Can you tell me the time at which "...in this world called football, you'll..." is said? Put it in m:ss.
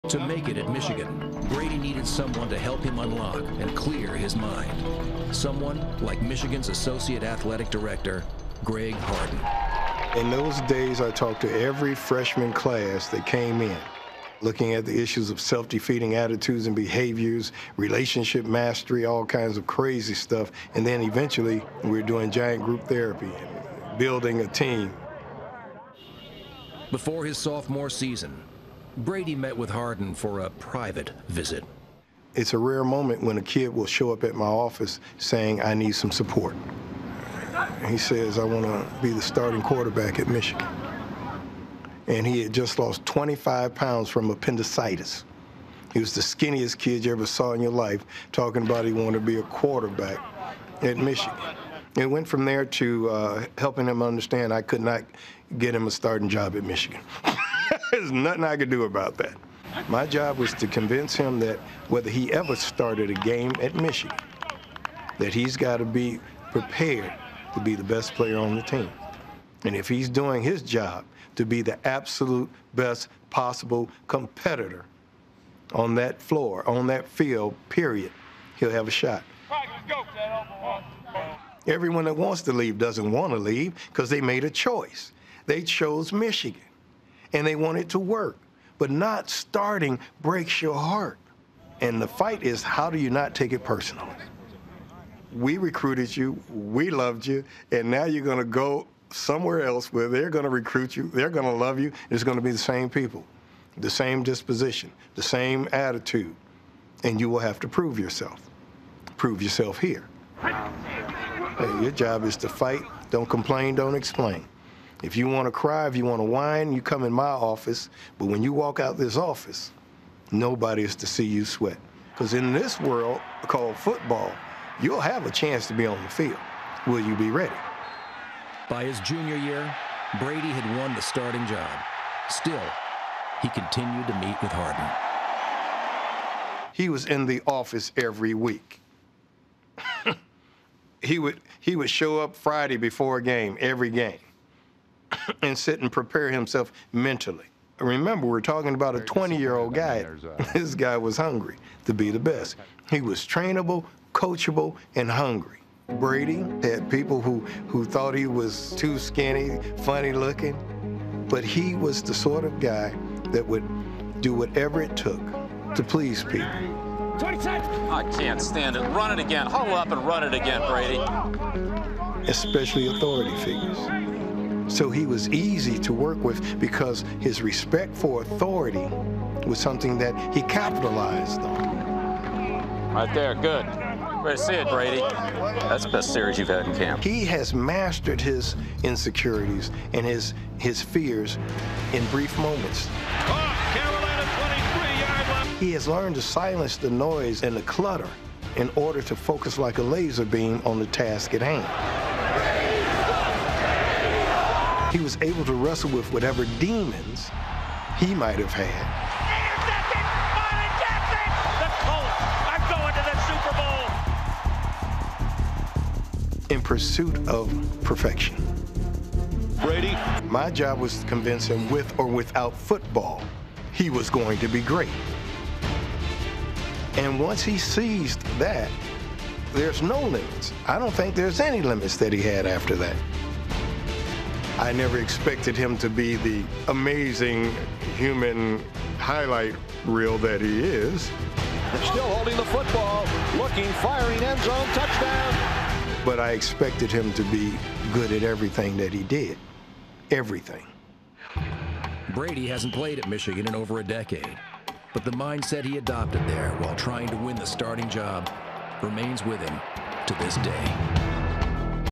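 2:02.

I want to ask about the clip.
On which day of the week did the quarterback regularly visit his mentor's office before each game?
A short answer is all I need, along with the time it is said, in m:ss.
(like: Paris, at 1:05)
Friday, at 2:22.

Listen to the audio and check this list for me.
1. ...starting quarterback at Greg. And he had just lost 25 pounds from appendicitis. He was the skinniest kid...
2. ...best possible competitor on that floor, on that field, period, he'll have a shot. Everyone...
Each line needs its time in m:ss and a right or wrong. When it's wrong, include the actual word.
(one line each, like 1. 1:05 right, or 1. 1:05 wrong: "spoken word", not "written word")
1. 0:39 wrong: "Michigan", not "Greg"
2. 1:12 right.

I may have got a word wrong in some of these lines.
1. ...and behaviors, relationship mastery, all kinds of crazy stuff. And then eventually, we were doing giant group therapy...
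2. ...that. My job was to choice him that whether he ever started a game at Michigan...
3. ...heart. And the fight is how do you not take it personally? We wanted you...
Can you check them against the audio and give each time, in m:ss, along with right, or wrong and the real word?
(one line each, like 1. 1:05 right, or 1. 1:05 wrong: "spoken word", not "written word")
1. 0:16 right
2. 0:59 wrong: "convince", not "choice"
3. 1:30 wrong: "recruited", not "wanted".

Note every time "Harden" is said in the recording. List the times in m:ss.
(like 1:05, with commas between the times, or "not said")
0:08, 0:29, 2:14.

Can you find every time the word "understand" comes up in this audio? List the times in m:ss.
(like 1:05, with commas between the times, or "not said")
0:54.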